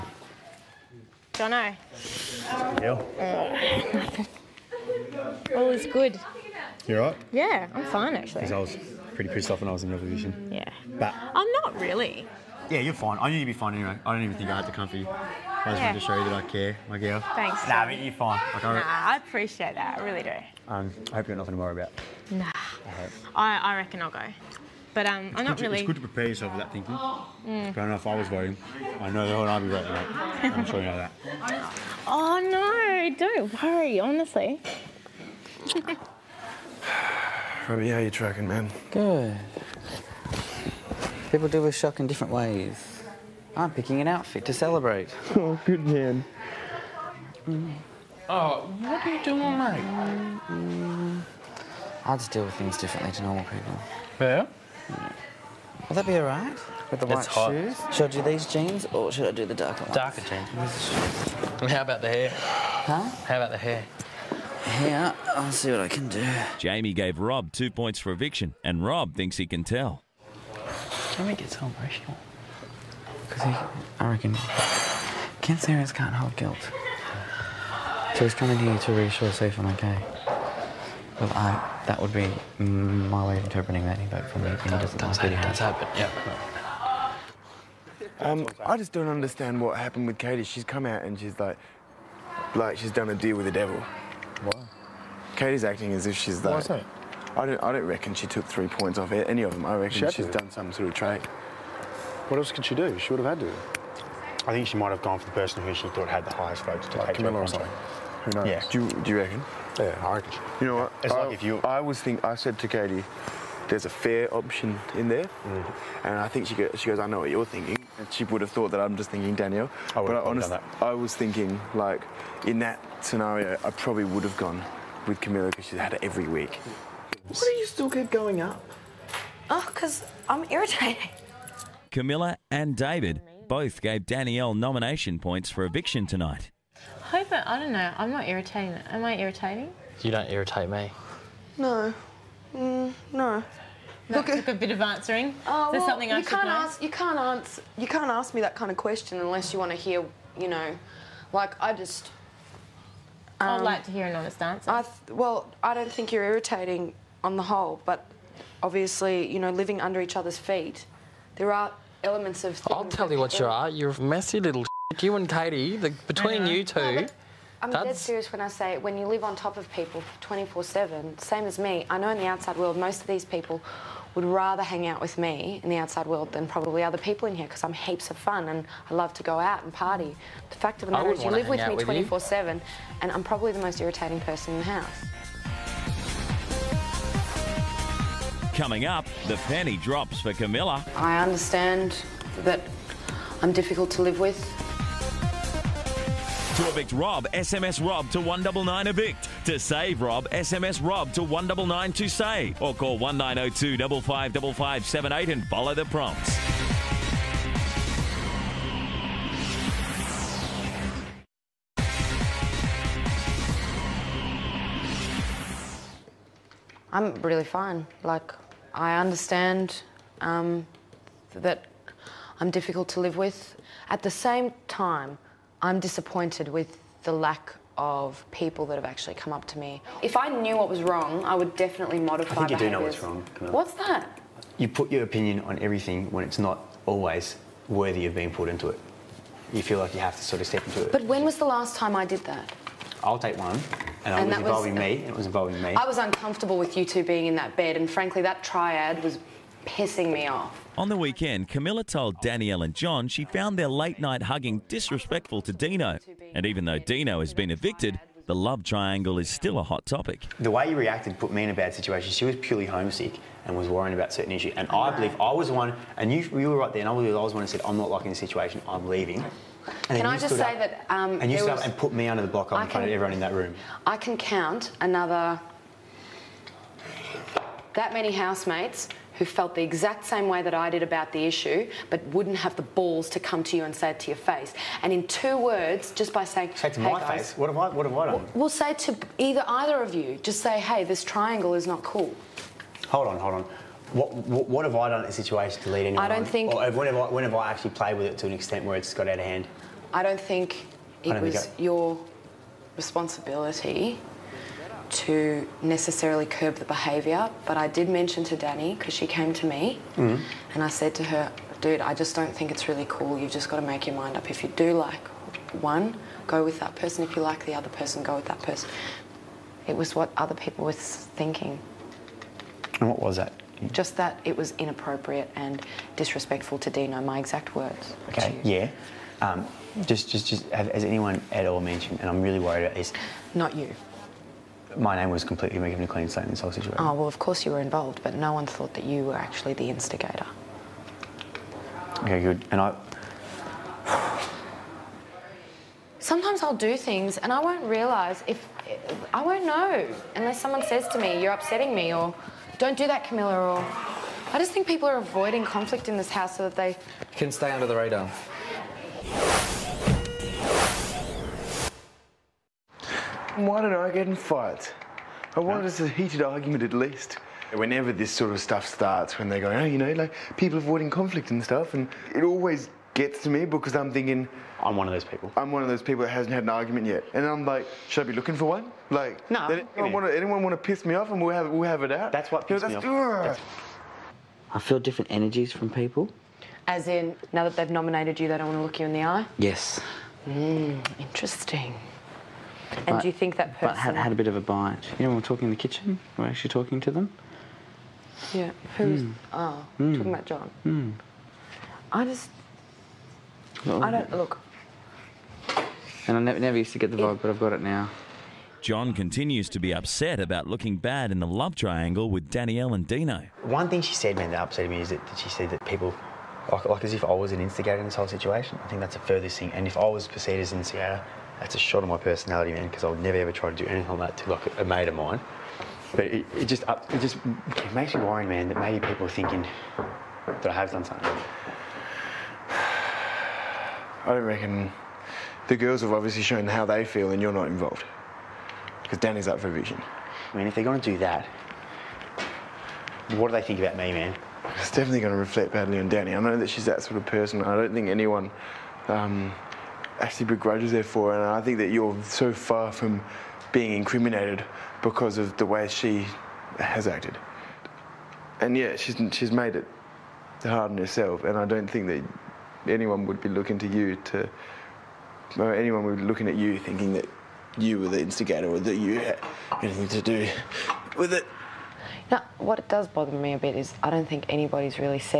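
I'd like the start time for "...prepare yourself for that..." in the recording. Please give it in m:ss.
0:26.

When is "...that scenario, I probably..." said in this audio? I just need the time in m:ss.
2:02.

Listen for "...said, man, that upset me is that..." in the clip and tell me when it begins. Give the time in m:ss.
6:53.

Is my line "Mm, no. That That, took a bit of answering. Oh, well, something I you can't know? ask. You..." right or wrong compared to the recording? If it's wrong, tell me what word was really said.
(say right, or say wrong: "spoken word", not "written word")
wrong: "Look", not "That".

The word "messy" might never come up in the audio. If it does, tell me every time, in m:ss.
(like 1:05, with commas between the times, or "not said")
2:44.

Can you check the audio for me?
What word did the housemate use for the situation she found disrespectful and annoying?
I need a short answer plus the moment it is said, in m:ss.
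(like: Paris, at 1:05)
triad, at 4:08.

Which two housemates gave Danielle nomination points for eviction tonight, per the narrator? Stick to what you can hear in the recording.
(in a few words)
Camilla and David.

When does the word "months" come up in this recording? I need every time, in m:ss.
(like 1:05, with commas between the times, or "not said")
not said.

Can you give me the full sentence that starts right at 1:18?
So he's coming here to reassure safe and okay.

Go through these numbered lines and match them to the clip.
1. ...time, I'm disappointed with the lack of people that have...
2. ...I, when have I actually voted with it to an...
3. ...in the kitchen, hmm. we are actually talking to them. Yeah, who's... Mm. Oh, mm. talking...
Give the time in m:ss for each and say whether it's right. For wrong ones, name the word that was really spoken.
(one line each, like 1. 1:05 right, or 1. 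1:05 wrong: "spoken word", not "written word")
1. 3:44 right
2. 4:56 wrong: "played", not "voted"
3. 6:35 right.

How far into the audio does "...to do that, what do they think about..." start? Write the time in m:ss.
7:20.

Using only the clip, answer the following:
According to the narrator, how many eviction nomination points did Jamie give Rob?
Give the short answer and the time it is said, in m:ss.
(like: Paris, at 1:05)
2, at 1:07.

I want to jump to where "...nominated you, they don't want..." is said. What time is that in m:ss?
6:27.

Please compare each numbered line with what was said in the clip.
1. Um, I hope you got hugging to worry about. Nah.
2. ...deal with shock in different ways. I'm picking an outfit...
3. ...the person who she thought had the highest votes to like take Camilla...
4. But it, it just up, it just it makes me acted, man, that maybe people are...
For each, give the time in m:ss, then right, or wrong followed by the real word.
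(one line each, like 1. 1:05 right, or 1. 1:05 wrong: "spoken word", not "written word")
1. 0:20 wrong: "nothing", not "hugging"
2. 0:41 right
3. 1:45 right
4. 7:05 wrong: "worried", not "acted".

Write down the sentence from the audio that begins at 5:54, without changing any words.
I just think people are avoiding conflict in this house so that they...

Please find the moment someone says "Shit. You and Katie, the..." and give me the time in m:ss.
2:44.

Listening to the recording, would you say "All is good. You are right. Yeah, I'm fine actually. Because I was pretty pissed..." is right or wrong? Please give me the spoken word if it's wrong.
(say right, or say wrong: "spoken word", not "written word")
right.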